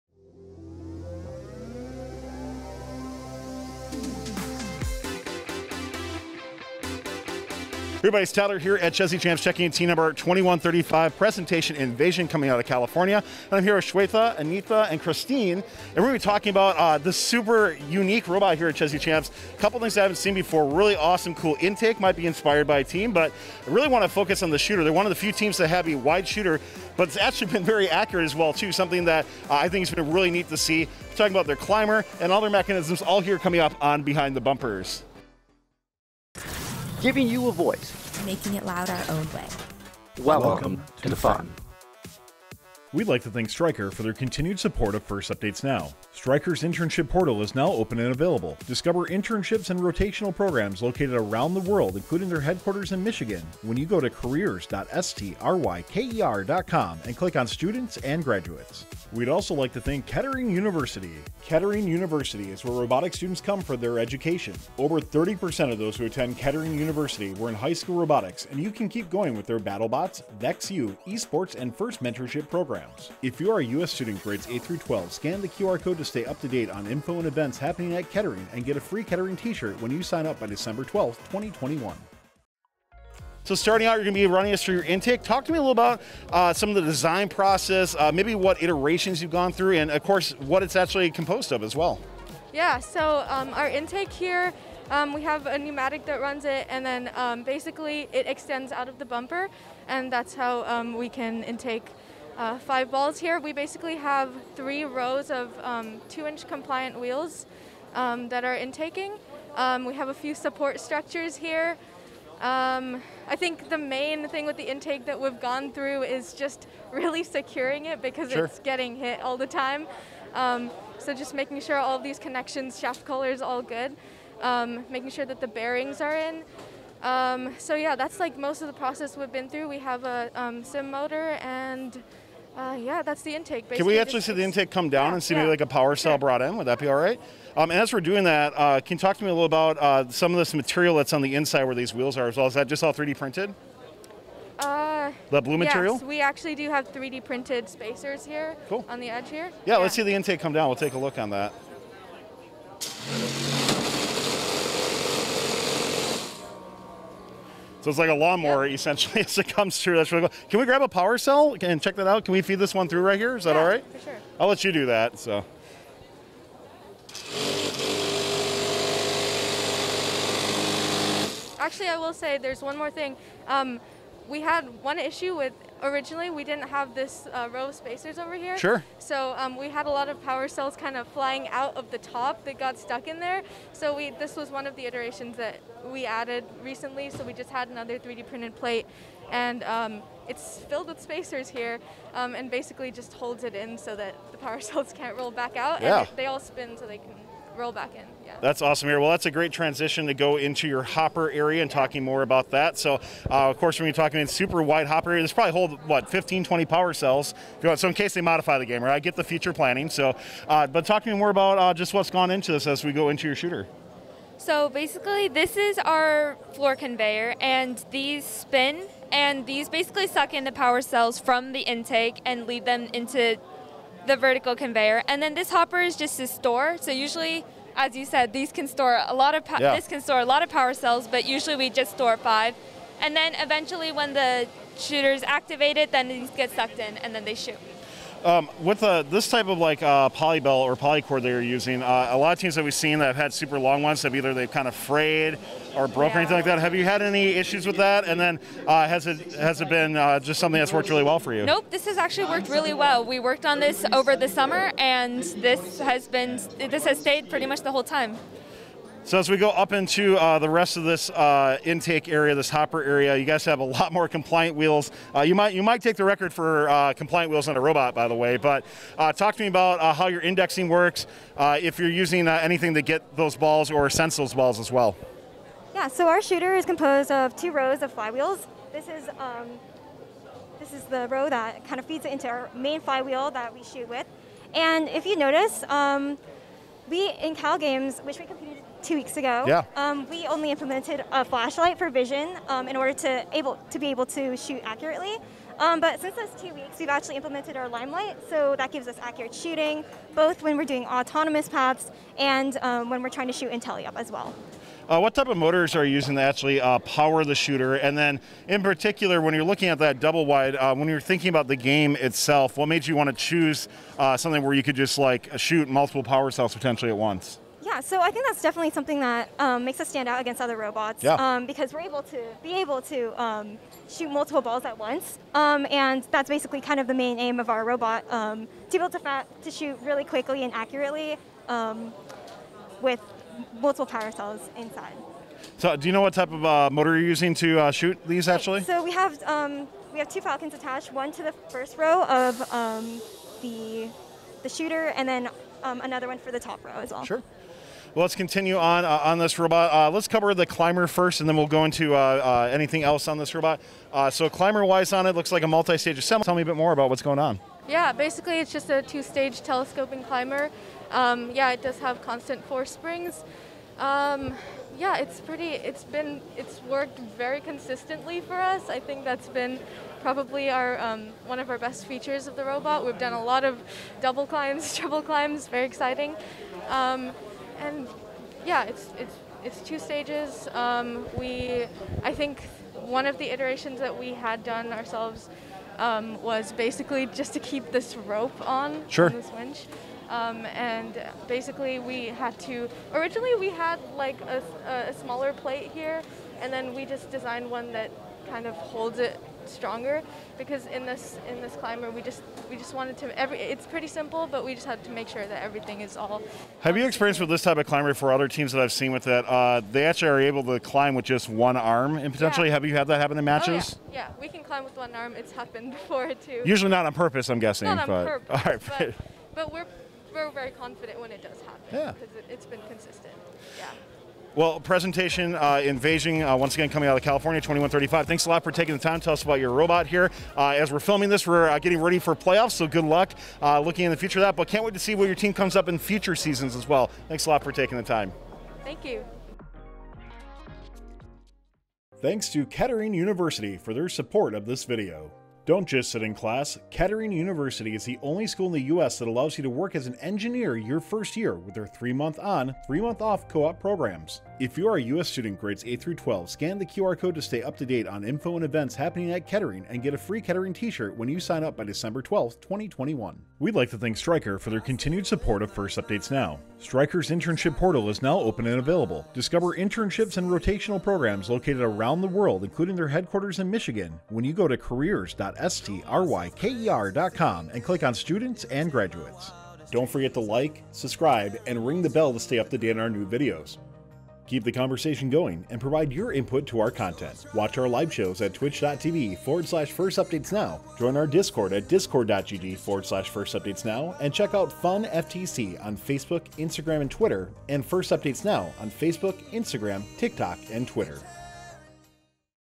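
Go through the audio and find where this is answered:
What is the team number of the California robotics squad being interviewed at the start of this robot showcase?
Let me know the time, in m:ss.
0:09.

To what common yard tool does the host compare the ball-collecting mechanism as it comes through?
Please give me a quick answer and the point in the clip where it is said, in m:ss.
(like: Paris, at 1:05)
Lawnmower, at 2:38.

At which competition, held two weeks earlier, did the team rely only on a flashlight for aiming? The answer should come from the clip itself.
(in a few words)
Cal Games.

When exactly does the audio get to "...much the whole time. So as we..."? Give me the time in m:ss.
4:17.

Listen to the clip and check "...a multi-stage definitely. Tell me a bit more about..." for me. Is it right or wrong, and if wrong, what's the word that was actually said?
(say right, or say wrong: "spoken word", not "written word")
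wrong: "assembly", not "definitely".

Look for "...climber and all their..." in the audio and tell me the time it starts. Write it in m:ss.
0:31.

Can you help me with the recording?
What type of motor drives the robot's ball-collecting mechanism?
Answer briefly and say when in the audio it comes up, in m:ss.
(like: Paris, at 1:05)
CIM, at 2:10.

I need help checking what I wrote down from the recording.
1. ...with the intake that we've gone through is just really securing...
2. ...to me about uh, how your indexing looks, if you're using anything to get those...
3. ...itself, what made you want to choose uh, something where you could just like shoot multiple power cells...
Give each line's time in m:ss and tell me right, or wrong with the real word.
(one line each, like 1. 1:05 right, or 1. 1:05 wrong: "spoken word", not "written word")
1. 1:54 right
2. 4:29 wrong: "works", not "looks"
3. 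5:11 right.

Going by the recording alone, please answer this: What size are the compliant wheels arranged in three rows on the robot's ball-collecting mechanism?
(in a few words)
2-inch.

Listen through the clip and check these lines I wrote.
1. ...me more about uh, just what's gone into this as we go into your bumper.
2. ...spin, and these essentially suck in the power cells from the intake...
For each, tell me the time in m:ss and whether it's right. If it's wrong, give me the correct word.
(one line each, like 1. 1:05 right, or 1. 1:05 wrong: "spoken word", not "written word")
1. 3:31 wrong: "shooter", not "bumper"
2. 3:38 wrong: "basically", not "essentially".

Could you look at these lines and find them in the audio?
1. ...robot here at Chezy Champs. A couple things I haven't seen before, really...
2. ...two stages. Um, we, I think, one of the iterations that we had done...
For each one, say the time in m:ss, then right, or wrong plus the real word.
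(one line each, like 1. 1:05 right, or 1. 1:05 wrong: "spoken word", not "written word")
1. 0:18 right
2. 6:19 right.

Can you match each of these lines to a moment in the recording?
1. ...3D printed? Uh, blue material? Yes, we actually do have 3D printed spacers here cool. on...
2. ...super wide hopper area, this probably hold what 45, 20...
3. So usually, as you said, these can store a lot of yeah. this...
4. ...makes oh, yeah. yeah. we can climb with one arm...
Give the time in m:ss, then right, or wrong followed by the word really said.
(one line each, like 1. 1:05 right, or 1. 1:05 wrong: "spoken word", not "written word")
1. 2:22 right
2. 3:24 wrong: "15", not "45"
3. 3:46 right
4. 6:53 wrong: "matches", not "makes".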